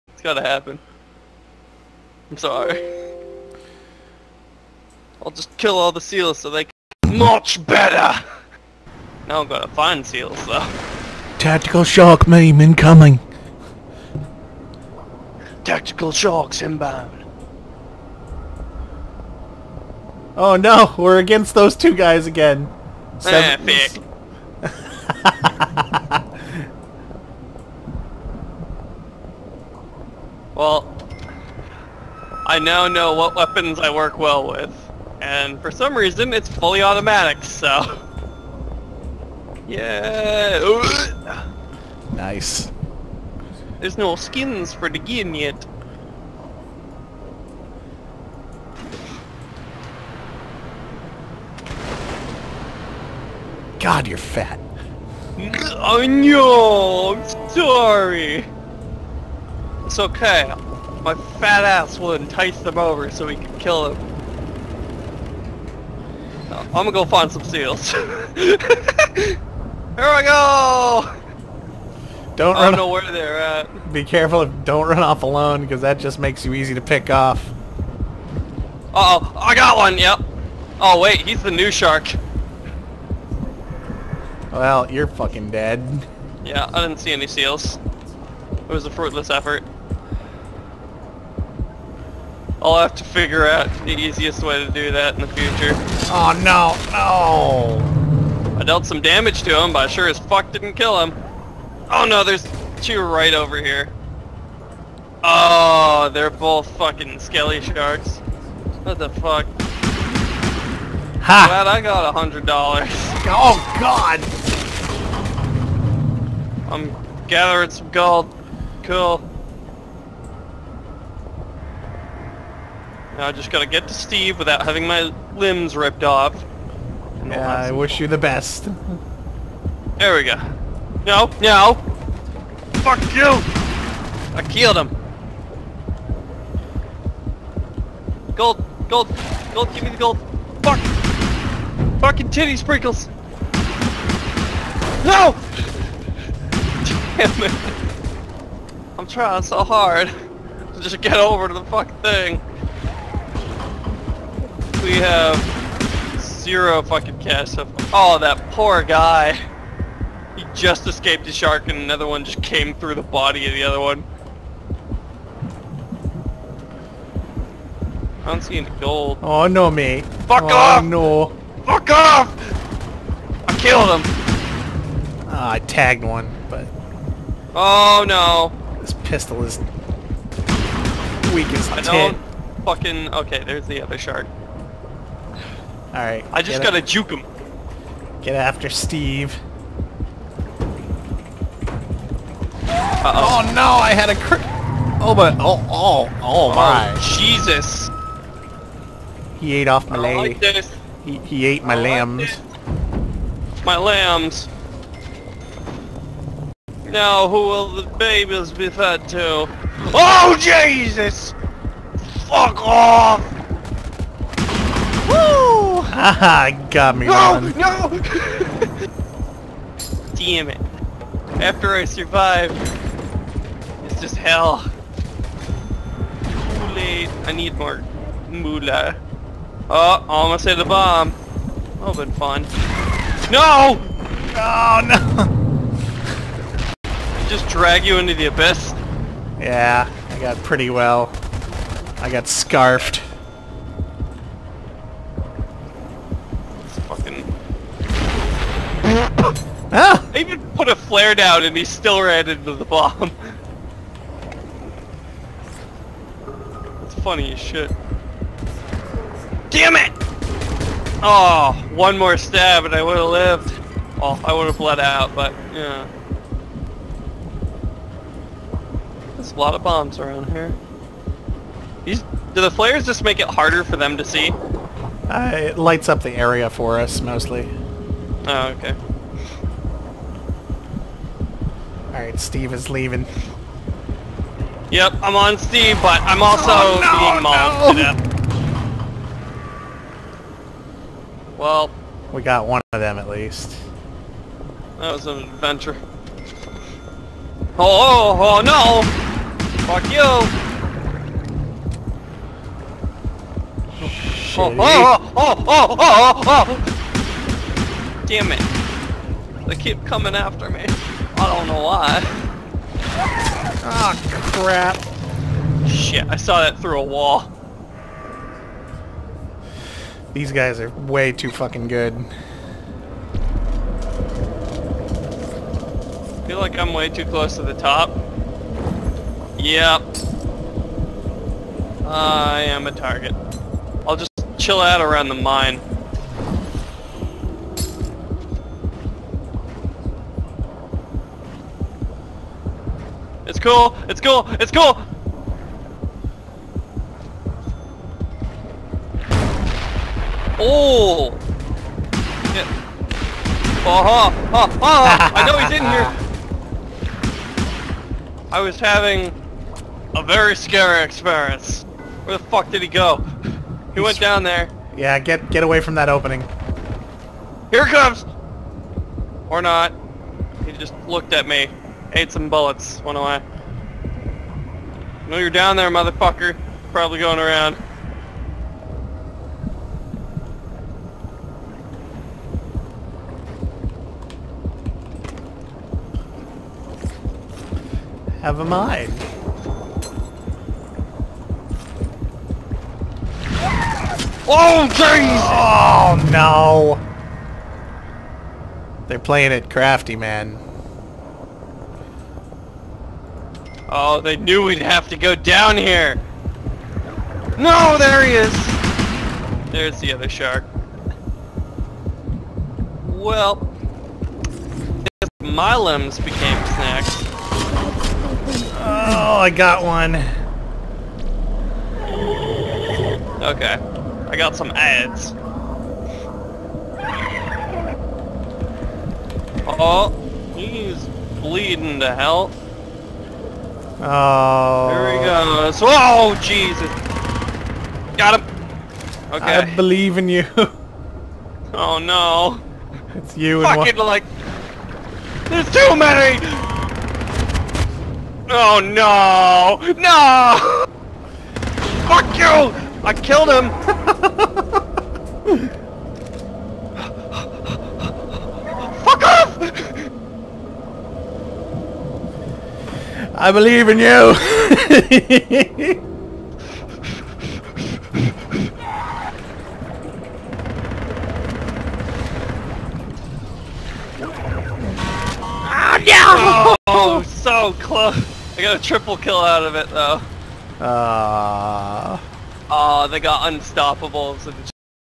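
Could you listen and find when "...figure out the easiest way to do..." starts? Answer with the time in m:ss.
1:33.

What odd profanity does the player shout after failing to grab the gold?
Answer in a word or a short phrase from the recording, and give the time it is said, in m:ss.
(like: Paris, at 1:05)
Titty sprinkles, at 2:22.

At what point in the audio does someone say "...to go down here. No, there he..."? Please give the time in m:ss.
6:44.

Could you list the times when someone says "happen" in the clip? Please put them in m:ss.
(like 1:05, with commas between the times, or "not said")
0:00.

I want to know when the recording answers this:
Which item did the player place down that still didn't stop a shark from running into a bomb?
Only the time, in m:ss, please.
4:10.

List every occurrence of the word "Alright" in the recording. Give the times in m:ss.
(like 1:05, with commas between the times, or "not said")
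3:05, 4:41.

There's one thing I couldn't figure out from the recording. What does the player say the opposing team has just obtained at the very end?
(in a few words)
Unstoppables.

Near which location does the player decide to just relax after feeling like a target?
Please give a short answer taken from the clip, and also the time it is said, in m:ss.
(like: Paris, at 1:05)
The mine, at 5:35.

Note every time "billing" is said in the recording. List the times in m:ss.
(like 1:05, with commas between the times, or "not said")
not said.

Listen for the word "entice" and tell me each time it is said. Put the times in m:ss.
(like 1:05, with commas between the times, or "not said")
1:02.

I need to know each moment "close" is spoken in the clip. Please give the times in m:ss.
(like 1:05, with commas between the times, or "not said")
5:27, 7:57.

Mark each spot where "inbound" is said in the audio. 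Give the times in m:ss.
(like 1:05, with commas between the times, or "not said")
0:16.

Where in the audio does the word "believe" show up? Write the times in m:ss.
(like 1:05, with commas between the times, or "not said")
7:19, 7:43.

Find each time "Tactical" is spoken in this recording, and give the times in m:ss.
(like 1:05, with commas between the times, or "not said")
0:11, 0:15.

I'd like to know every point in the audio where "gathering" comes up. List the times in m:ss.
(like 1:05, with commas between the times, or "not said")
1:57.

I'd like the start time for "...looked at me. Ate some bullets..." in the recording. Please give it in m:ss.
6:10.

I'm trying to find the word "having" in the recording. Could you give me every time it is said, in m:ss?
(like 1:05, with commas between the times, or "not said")
2:04, 5:58.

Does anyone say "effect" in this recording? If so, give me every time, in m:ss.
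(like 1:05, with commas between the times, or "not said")
not said.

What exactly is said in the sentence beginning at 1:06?
I'm gonna go find some seals.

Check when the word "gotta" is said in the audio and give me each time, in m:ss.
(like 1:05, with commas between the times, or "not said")
0:00, 2:03, 3:06.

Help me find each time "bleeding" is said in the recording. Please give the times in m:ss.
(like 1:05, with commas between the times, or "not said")
7:11.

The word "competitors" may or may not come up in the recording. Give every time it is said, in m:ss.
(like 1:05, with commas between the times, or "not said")
not said.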